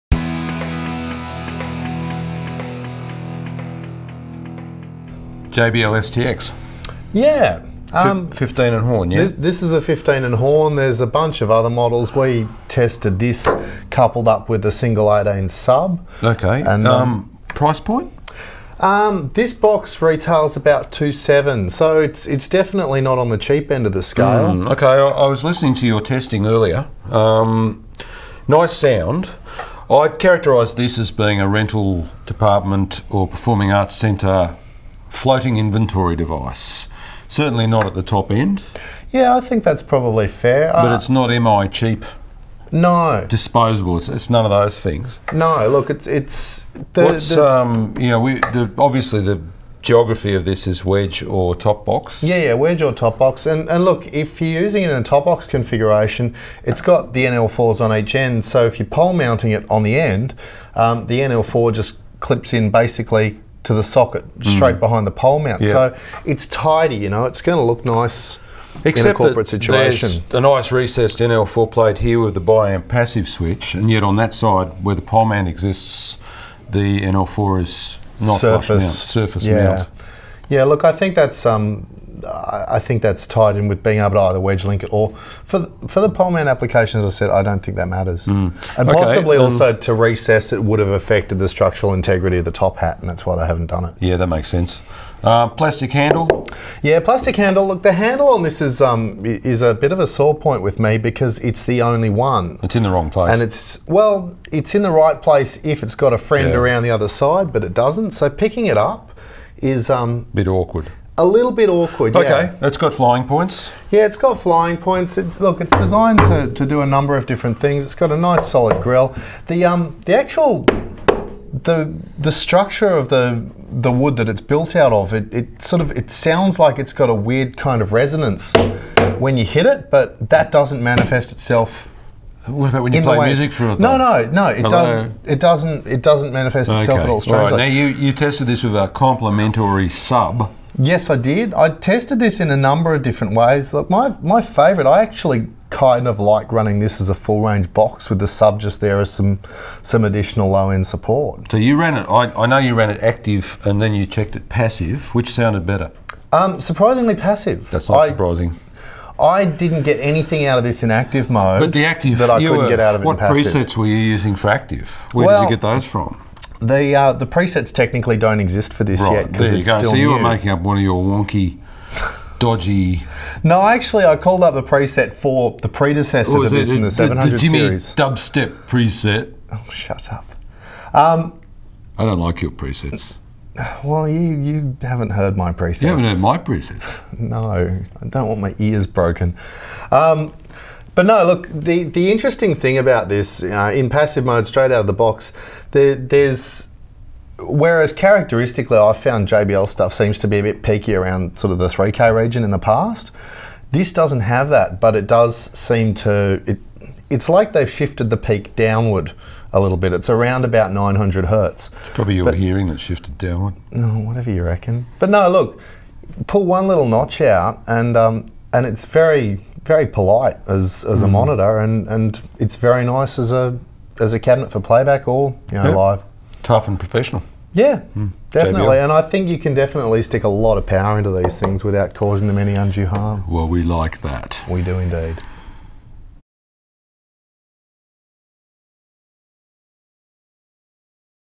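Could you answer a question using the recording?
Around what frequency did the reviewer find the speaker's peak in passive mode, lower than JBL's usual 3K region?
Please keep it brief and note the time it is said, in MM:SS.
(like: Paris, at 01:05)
900 hertz, at 03:30.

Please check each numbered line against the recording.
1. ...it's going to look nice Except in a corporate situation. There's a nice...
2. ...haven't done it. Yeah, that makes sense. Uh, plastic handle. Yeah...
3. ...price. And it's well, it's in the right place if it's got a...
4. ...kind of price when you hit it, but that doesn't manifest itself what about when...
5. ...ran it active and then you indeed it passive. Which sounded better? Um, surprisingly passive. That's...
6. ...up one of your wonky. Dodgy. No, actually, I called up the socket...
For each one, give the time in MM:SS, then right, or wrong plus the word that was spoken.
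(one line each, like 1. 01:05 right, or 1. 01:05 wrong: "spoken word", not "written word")
1. 01:07 right
2. 01:33 right
3. 01:43 wrong: "place", not "price"
4. 02:07 wrong: "resonance", not "price"
5. 02:32 wrong: "checked", not "indeed"
6. 02:50 wrong: "preset", not "socket".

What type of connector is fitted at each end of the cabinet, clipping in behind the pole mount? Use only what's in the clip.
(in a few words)
NL4.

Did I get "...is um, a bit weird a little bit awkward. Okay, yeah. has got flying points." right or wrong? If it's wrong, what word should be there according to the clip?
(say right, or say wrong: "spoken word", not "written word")
wrong: "awkward", not "weird".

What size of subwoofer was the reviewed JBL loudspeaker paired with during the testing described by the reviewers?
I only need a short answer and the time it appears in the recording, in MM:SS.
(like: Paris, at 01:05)
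single 18, at 00:14.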